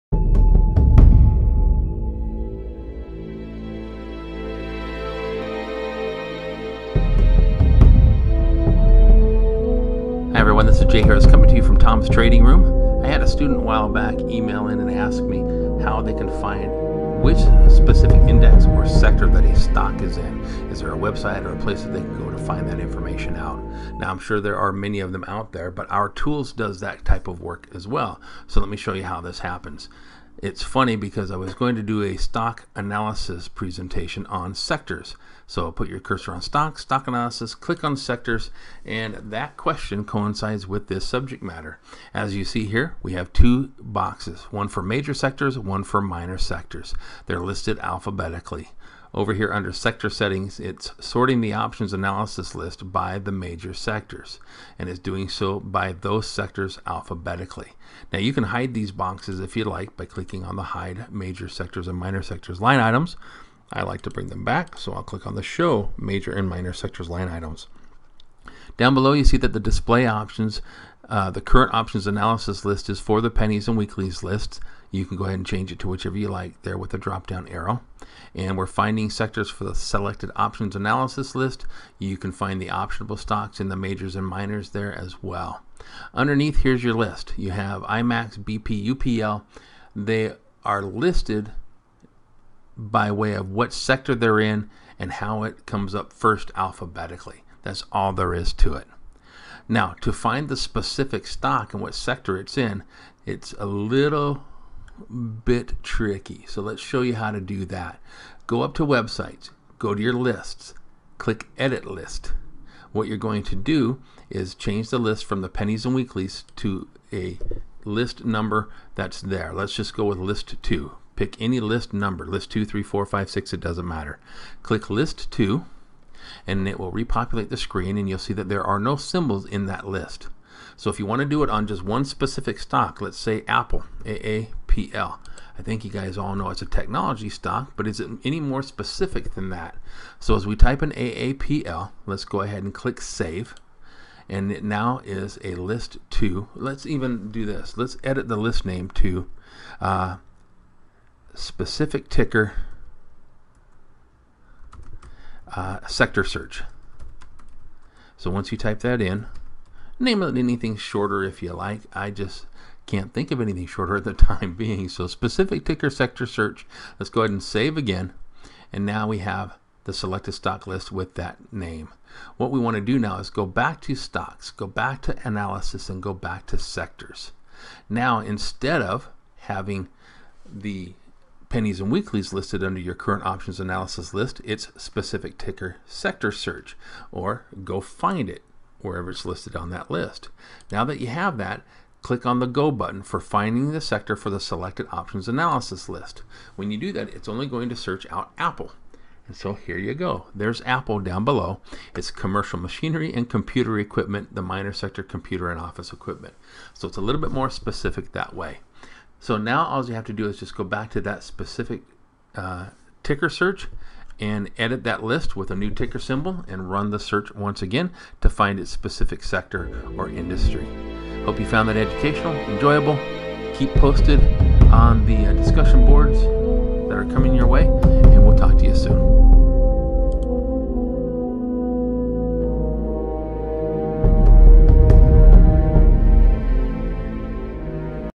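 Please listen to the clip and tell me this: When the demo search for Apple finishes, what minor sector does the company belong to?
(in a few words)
computer and office equipment.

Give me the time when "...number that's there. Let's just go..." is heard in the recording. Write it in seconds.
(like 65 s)
118 s.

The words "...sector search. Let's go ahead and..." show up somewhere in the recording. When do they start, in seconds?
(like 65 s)
165 s.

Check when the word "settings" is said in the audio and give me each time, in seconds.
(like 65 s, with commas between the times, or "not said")
50 s.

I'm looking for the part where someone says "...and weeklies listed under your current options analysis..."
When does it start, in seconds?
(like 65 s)
181 s.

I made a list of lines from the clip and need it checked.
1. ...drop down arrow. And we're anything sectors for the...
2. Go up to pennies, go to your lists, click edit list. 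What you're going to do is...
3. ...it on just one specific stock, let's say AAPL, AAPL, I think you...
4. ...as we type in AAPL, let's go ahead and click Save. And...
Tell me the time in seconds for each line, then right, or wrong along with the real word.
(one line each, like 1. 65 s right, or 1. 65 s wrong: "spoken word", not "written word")
1. 76 s wrong: "finding", not "anything"
2. 108 s wrong: "websites", not "pennies"
3. 131 s wrong: "Apple", not "AAPL"
4. 140 s right.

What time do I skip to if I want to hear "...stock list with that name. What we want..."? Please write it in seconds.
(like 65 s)
170 s.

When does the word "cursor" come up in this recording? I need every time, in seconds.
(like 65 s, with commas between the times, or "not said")
35 s.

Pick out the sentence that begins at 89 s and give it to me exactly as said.
They are listed by way of what sector they're in and how it comes up first alphabetically.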